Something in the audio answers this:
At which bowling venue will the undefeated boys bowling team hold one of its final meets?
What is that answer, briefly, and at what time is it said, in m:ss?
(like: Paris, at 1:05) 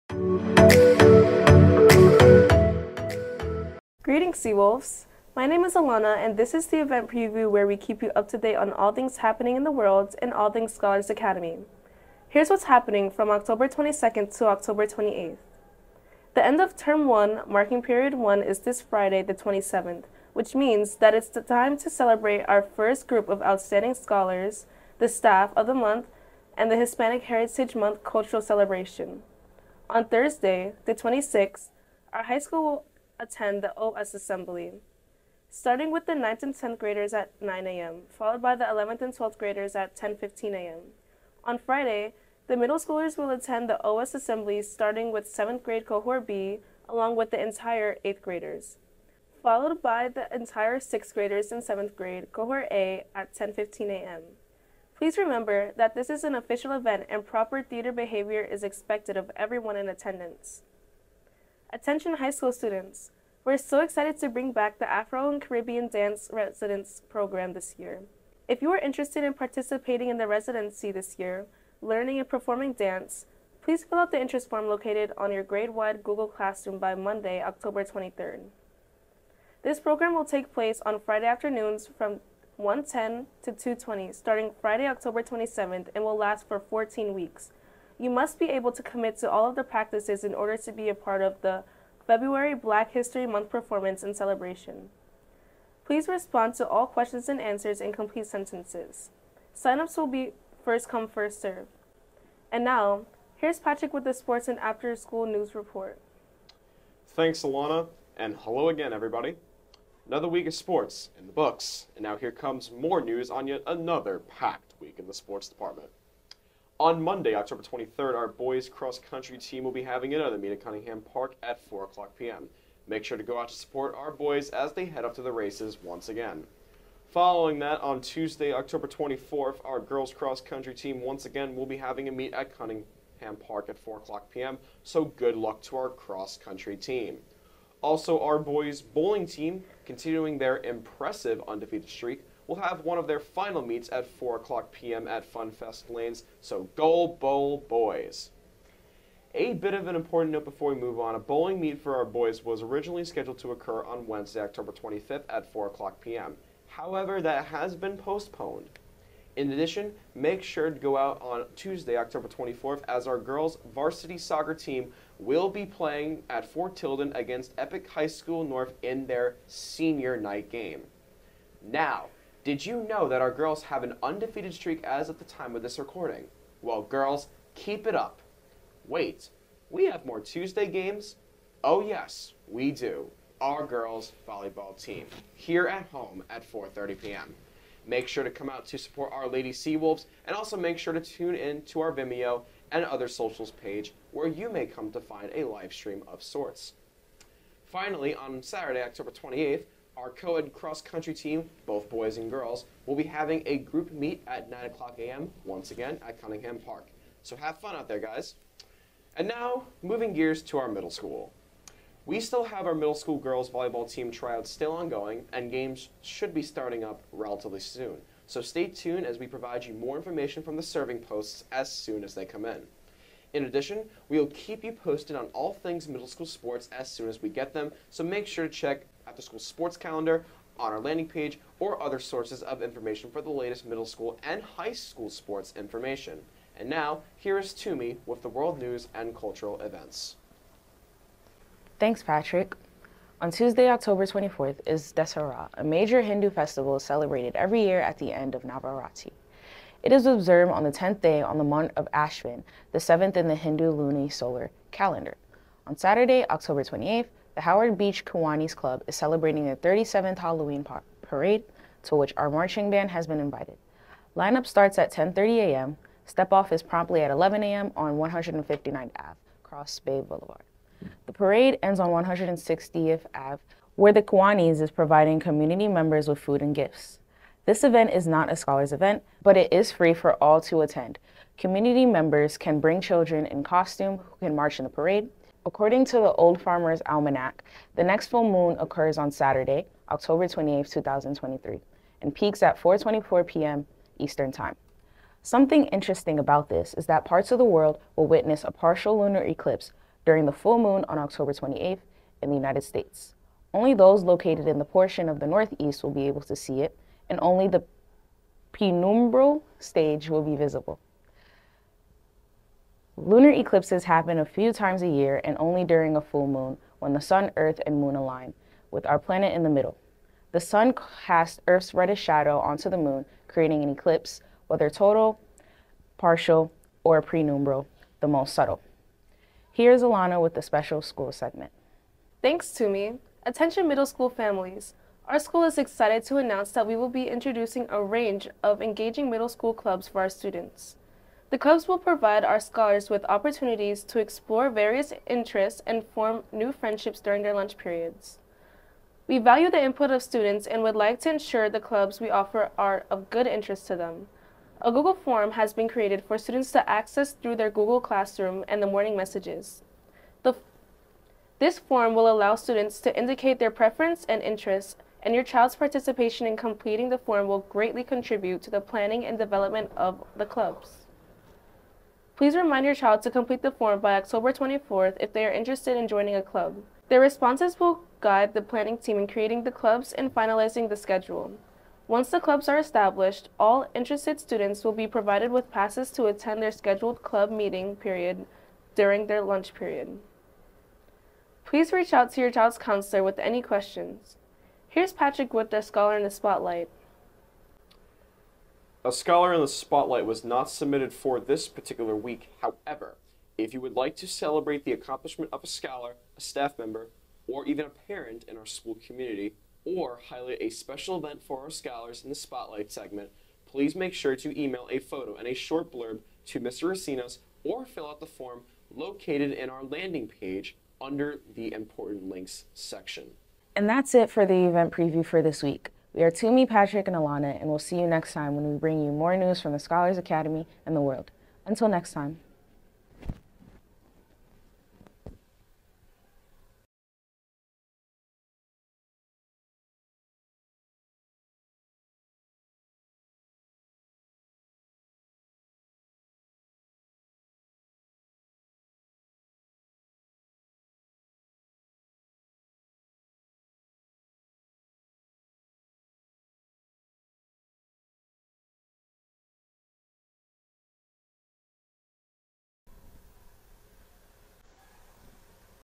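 FunFest Lanes, at 2:25.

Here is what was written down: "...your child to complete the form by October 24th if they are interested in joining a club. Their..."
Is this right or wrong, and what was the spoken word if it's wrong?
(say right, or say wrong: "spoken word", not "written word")
right.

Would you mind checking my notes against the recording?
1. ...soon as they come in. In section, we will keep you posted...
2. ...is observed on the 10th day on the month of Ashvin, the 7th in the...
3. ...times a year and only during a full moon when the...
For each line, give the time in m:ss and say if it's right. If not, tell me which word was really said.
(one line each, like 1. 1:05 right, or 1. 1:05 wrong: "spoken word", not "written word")
1. 3:41 wrong: "addition", not "section"
2. 4:09 right
3. 5:14 right.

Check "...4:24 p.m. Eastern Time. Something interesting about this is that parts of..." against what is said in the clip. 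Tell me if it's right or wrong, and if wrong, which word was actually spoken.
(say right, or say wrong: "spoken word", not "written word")
right.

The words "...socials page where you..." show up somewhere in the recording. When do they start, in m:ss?
3:13.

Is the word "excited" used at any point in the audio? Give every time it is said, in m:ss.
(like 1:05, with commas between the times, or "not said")
1:03, 5:35.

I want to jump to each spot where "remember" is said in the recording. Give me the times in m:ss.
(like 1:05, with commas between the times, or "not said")
0:55.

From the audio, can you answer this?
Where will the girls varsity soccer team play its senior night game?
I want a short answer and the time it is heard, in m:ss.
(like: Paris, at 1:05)
Fort Tilden, at 2:46.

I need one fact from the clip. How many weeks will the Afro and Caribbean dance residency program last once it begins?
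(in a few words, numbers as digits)
14.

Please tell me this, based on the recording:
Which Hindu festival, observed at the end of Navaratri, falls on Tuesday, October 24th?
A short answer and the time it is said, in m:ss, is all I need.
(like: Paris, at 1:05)
Dasara, at 4:04.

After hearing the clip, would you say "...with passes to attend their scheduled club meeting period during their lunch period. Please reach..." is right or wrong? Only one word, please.
right.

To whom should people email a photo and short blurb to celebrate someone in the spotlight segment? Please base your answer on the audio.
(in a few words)
Mr. Recinos.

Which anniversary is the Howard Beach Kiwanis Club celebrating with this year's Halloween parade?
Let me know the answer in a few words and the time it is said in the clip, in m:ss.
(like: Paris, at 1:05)
37th, at 4:19.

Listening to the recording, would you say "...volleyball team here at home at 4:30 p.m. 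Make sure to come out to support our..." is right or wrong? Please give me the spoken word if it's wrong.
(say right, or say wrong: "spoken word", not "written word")
right.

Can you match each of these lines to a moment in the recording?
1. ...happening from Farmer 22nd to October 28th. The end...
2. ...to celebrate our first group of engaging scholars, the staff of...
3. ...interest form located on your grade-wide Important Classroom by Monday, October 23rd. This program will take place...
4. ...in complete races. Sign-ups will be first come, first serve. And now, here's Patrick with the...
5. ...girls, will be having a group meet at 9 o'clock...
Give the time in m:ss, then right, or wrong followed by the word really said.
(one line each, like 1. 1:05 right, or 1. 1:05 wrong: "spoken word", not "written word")
1. 0:12 wrong: "October", not "Farmer"
2. 0:21 wrong: "outstanding", not "engaging"
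3. 1:14 wrong: "Google", not "Important"
4. 1:37 wrong: "sentences", not "races"
5. 3:22 right.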